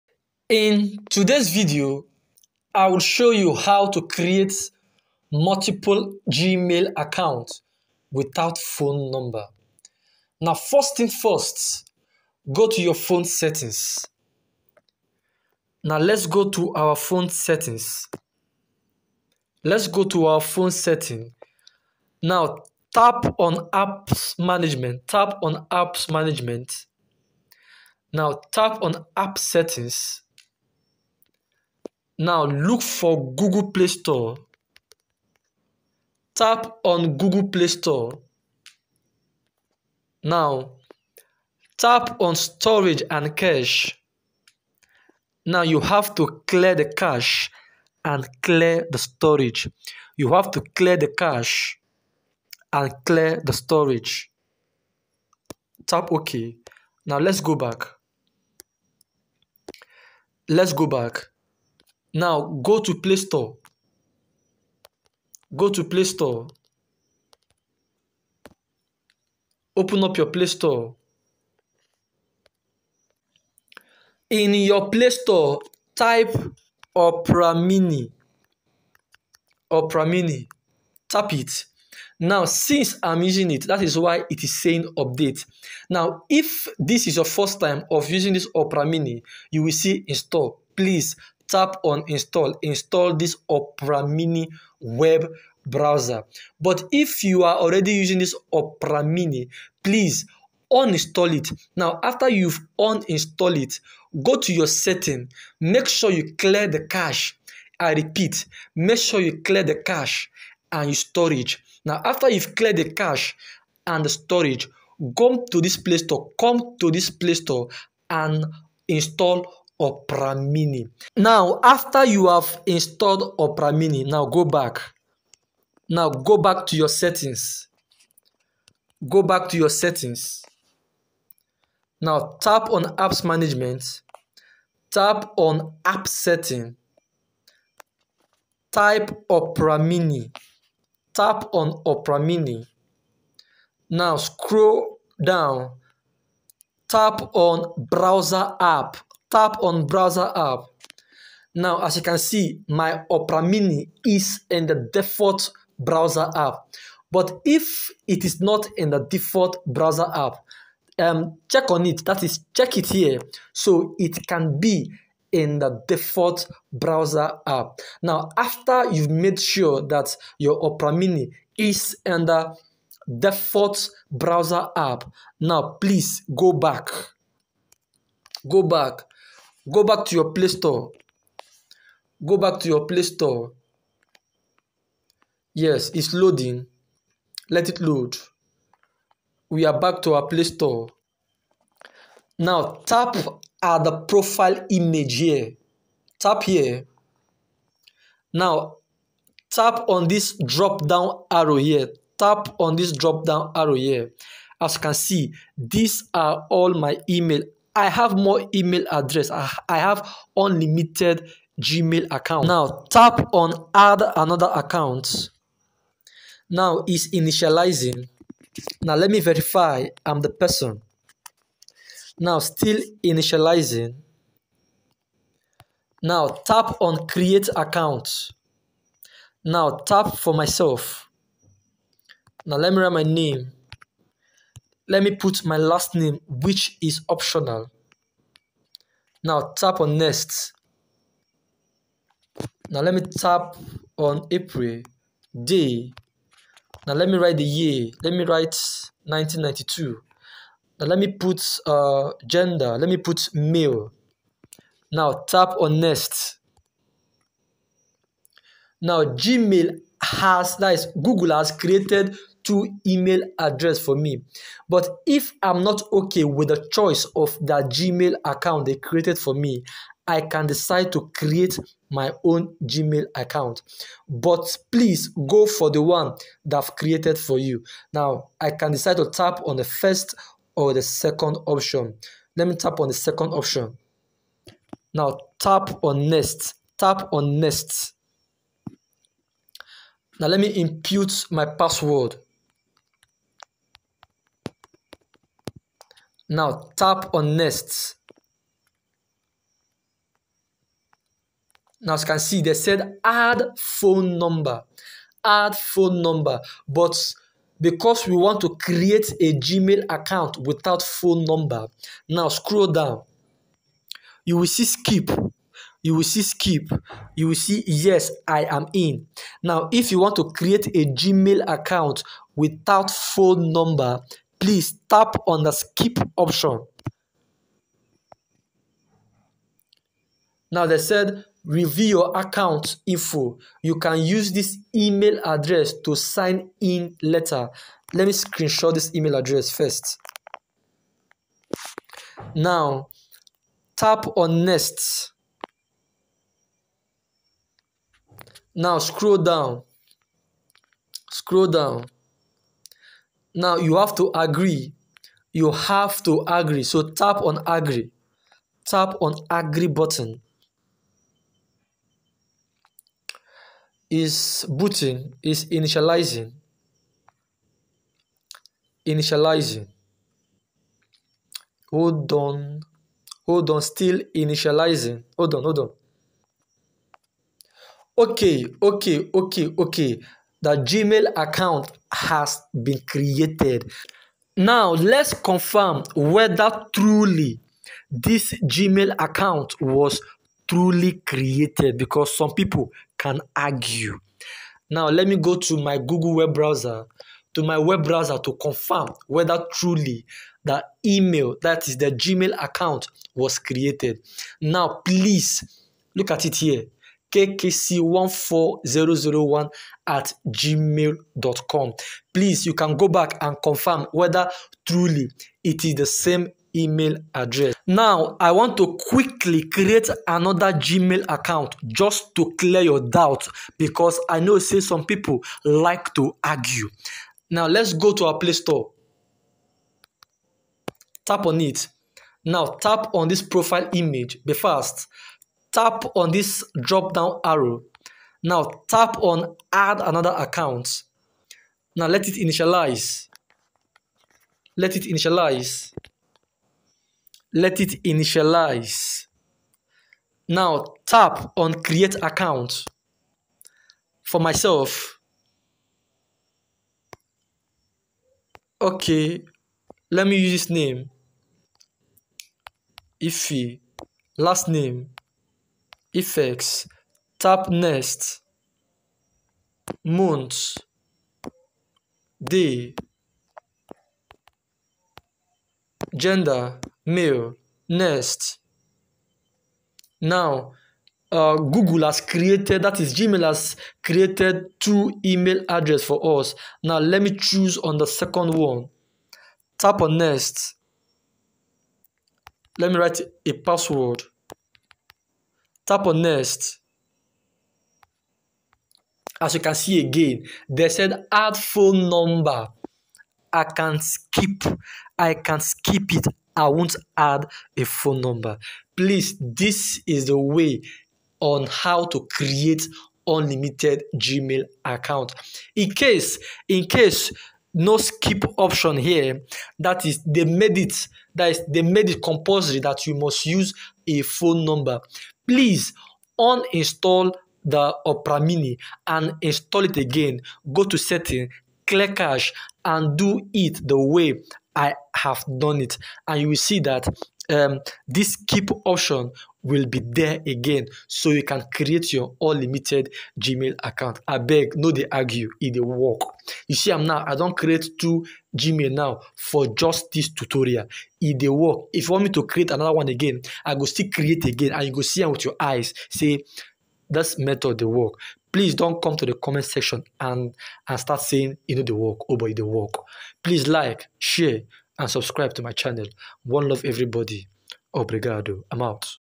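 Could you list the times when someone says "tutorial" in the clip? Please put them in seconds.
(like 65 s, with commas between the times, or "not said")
550 s.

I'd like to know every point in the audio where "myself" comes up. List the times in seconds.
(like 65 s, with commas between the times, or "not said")
230 s, 454 s.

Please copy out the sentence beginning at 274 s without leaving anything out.
But please go for the one that I've created for you.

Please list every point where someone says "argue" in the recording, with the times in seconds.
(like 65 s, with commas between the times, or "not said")
393 s, 426 s, 544 s.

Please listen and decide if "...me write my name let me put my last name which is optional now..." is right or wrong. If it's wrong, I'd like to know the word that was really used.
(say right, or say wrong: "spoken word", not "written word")
right.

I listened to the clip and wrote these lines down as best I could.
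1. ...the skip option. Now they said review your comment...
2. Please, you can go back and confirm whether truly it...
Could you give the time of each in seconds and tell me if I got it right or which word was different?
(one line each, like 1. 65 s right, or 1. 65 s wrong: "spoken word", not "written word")
1. 325 s wrong: "account", not "comment"
2. 412 s right.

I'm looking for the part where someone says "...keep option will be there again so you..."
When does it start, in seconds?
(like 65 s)
538 s.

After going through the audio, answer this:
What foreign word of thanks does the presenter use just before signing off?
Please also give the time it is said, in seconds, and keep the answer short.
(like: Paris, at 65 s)
Obrigado, at 567 s.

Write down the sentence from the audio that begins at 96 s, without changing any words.
But if you are already using this Opera Mini, please uninstall it.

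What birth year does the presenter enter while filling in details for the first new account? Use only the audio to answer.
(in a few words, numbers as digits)
1992.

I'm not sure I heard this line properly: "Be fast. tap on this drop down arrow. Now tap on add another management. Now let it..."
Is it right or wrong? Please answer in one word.
wrong.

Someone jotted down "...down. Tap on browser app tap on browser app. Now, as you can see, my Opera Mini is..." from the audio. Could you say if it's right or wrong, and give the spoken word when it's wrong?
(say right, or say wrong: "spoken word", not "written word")
right.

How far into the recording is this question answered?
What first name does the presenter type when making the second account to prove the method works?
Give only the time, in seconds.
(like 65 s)
463 s.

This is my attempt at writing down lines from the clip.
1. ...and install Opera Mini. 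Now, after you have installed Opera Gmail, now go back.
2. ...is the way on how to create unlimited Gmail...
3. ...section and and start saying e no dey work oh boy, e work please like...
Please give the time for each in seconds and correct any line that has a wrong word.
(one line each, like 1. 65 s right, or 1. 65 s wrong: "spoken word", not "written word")
1. 118 s wrong: "Mini", not "Gmail"
2. 509 s right
3. 559 s right.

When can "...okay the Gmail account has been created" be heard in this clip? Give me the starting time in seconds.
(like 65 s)
379 s.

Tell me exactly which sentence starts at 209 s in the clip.
I, I have unlimited Gmail account.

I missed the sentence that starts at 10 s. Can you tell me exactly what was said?
Now, first thing first, go to your phone settings.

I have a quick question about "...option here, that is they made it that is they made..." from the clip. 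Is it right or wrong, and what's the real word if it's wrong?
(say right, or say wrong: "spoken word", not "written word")
right.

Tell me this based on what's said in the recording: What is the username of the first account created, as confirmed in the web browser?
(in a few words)
kkc14001.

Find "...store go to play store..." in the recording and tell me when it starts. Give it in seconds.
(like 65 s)
63 s.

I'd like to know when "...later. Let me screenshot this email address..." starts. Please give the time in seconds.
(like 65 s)
337 s.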